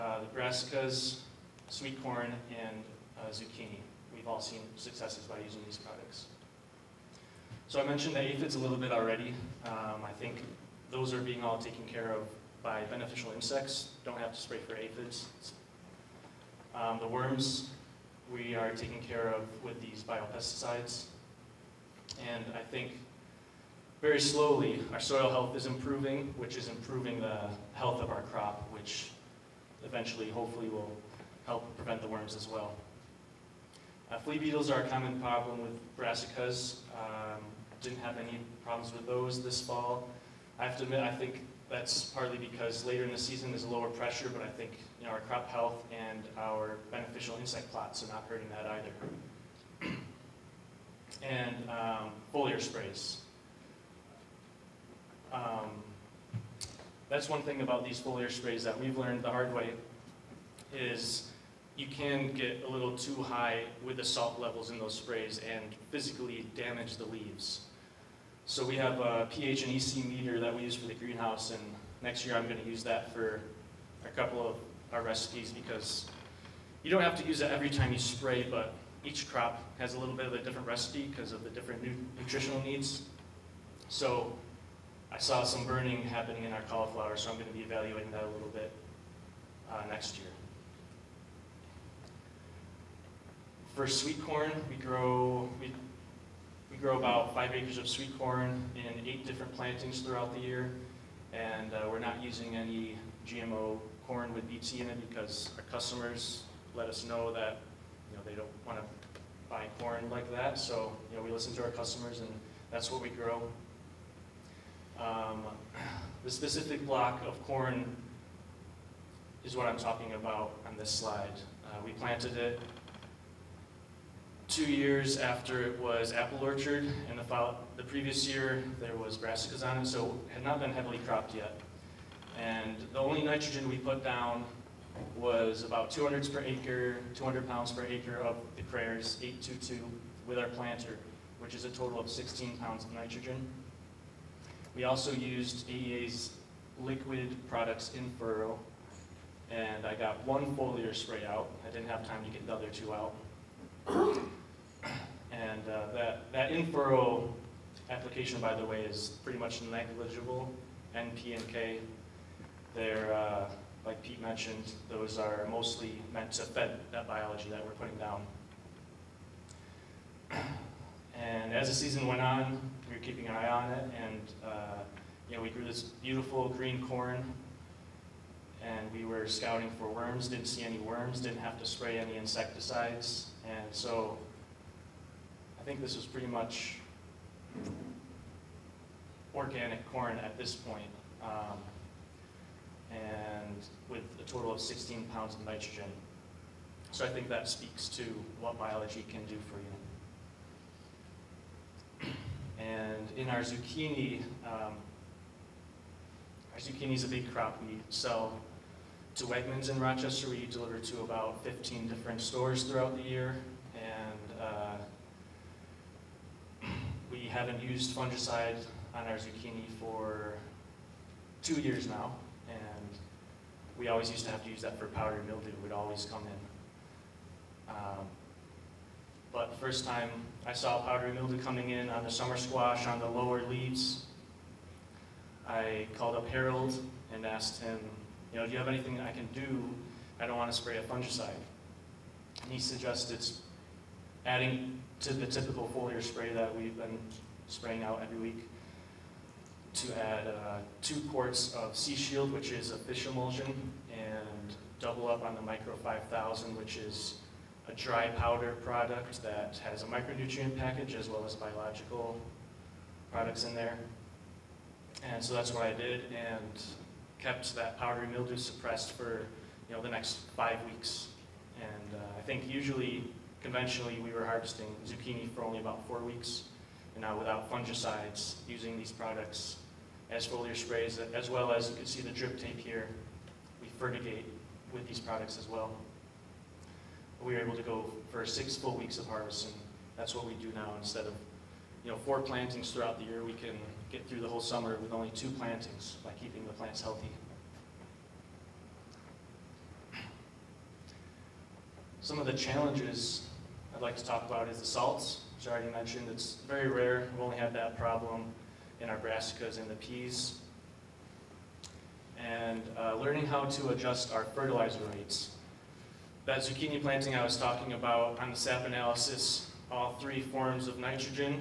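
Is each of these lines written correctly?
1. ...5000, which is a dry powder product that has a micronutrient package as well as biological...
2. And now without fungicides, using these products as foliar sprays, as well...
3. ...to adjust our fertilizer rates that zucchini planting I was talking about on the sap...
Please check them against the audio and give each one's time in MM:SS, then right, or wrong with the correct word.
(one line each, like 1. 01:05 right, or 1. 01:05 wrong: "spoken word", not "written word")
1. 04:15 right
2. 04:36 right
3. 05:13 right.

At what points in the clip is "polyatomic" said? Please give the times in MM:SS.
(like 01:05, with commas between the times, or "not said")
not said.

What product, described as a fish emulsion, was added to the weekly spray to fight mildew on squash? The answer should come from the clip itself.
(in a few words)
Sea Shield.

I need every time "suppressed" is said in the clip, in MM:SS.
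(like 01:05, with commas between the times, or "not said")
04:28.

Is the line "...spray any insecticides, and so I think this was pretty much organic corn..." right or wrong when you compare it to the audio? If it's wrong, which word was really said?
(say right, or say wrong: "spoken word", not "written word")
right.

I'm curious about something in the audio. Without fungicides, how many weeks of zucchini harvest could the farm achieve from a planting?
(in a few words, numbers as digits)
6.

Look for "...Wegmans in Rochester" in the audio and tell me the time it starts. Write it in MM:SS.
03:29.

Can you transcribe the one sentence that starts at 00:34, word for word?
Uh, flea beetles are a common problem with brassicas.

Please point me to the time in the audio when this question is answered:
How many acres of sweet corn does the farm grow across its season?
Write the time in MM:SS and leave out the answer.
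01:37.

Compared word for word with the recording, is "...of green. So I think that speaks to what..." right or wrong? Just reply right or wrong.
wrong.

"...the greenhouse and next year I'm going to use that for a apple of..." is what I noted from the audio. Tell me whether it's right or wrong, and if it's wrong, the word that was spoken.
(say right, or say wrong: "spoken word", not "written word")
wrong: "couple", not "apple".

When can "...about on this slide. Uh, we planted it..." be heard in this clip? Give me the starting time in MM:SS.
02:00.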